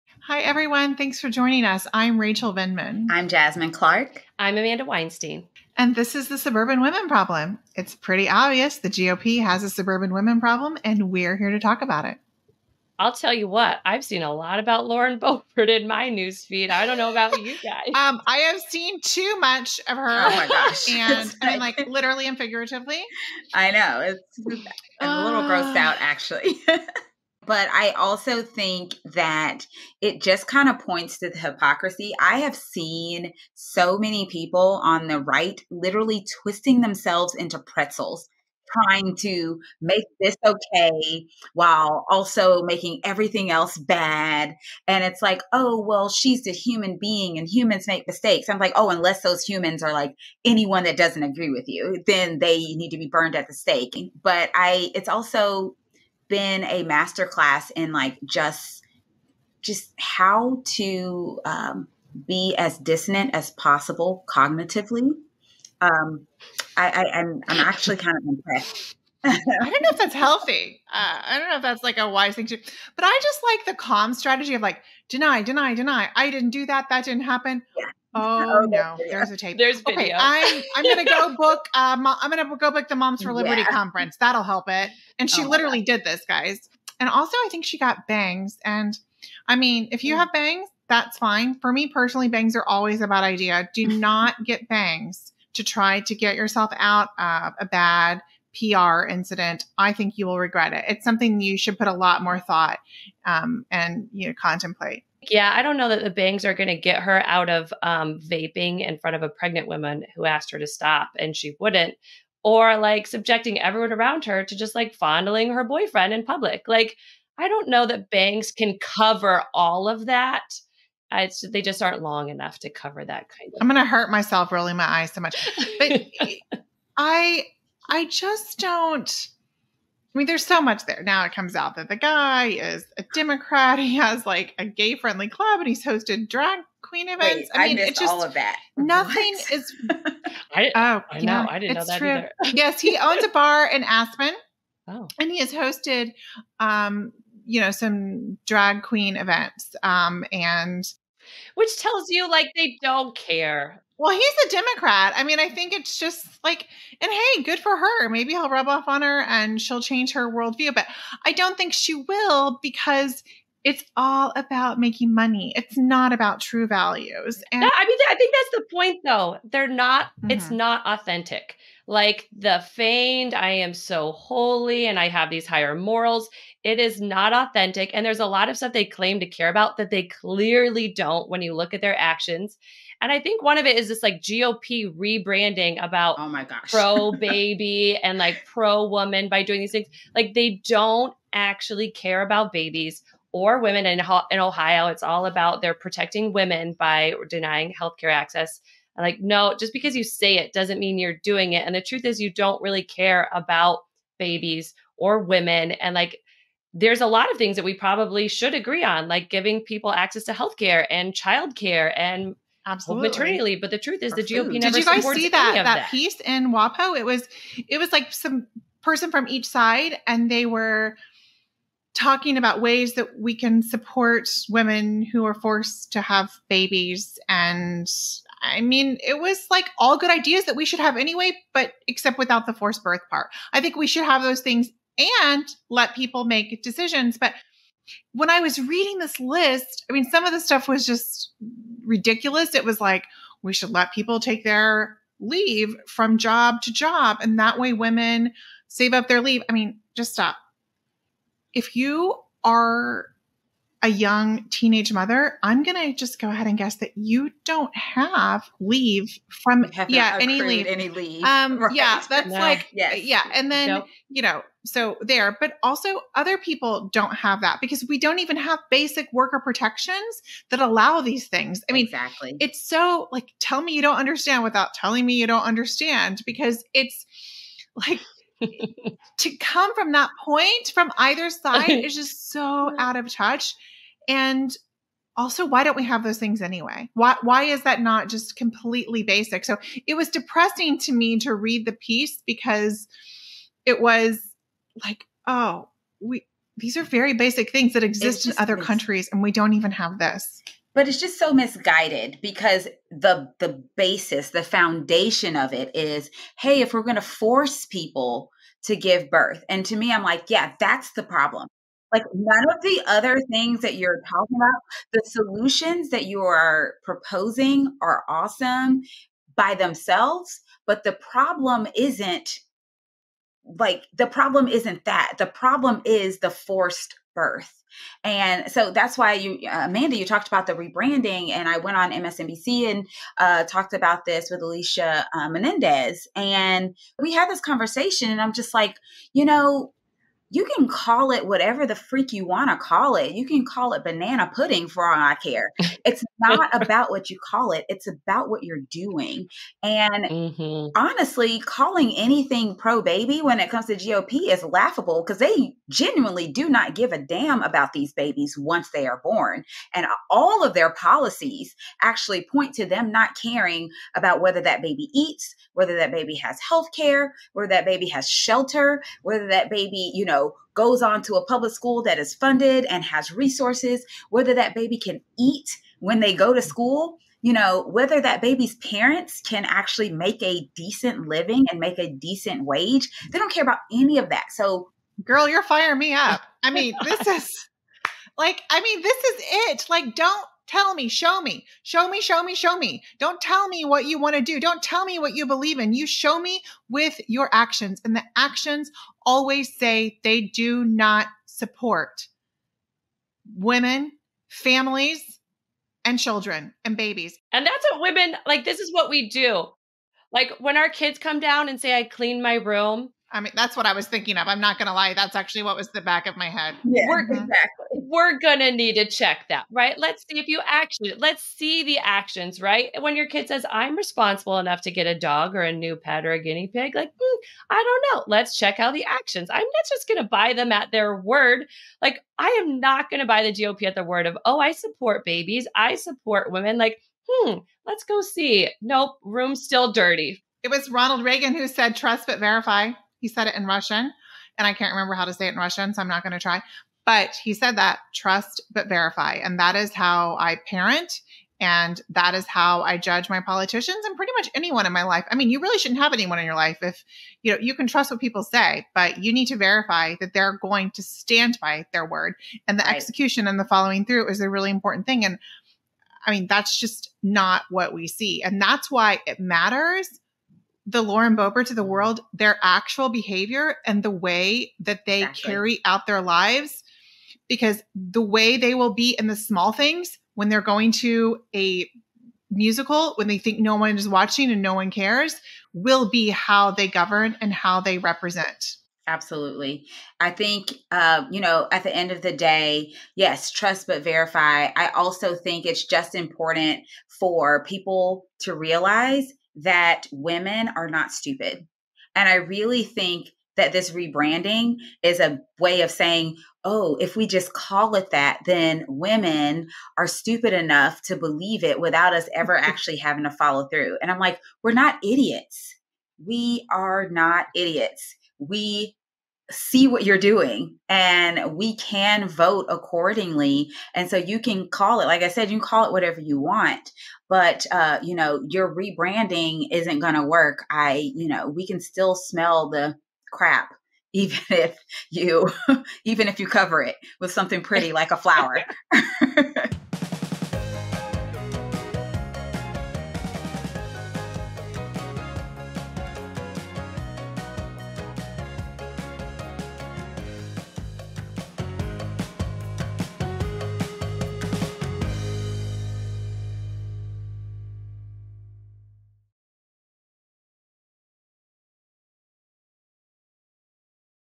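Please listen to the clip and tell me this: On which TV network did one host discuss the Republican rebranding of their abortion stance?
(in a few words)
MSNBC.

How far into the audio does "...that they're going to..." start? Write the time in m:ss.
7:39.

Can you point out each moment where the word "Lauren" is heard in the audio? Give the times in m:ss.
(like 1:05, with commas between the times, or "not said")
0:14, 7:50.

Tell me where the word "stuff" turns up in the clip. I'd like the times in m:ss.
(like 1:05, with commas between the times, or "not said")
2:58, 4:00.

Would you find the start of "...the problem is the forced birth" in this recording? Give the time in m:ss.
5:25.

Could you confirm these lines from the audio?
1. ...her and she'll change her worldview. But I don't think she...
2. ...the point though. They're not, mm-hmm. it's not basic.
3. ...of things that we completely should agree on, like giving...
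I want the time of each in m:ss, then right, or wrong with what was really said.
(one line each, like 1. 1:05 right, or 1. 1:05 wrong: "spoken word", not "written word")
1. 2:39 right
2. 2:48 wrong: "authentic", not "basic"
3. 3:27 wrong: "probably", not "completely".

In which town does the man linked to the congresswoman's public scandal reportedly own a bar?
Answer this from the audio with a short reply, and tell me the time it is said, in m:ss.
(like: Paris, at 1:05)
Aspen, at 2:23.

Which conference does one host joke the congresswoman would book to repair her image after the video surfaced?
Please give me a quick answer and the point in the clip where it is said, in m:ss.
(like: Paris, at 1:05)
Moms for Liberty, at 1:22.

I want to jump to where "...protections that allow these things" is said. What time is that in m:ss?
4:29.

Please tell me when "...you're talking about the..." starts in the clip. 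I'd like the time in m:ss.
5:13.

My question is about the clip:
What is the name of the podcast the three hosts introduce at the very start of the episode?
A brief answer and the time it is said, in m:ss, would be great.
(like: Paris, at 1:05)
The Suburban Women Problem, at 0:06.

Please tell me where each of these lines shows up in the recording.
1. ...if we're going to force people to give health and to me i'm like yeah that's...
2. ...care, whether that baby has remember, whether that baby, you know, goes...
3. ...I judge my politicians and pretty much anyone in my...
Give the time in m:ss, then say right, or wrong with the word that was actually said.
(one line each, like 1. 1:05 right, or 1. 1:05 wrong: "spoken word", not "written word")
1. 5:06 wrong: "birth", not "health"
2. 6:06 wrong: "shelter", not "remember"
3. 7:32 right.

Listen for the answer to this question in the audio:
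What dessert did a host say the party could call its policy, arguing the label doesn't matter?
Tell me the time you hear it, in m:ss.
5:43.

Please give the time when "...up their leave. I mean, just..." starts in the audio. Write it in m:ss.
4:08.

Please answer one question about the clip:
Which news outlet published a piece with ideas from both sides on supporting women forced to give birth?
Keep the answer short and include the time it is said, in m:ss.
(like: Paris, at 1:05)
WaPo, at 3:36.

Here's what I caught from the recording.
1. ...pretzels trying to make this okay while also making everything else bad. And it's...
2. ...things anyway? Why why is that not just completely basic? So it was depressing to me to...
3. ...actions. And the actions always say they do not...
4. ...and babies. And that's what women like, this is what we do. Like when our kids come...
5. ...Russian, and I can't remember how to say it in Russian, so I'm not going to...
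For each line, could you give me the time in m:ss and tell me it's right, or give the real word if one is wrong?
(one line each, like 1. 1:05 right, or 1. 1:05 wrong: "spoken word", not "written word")
1. 0:37 right
2. 4:46 right
3. 6:37 right
4. 6:46 right
5. 7:23 right.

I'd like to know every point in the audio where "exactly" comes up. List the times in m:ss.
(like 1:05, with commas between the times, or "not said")
4:31, 6:57, 7:55.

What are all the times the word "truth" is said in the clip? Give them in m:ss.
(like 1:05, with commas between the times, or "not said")
3:21, 3:33.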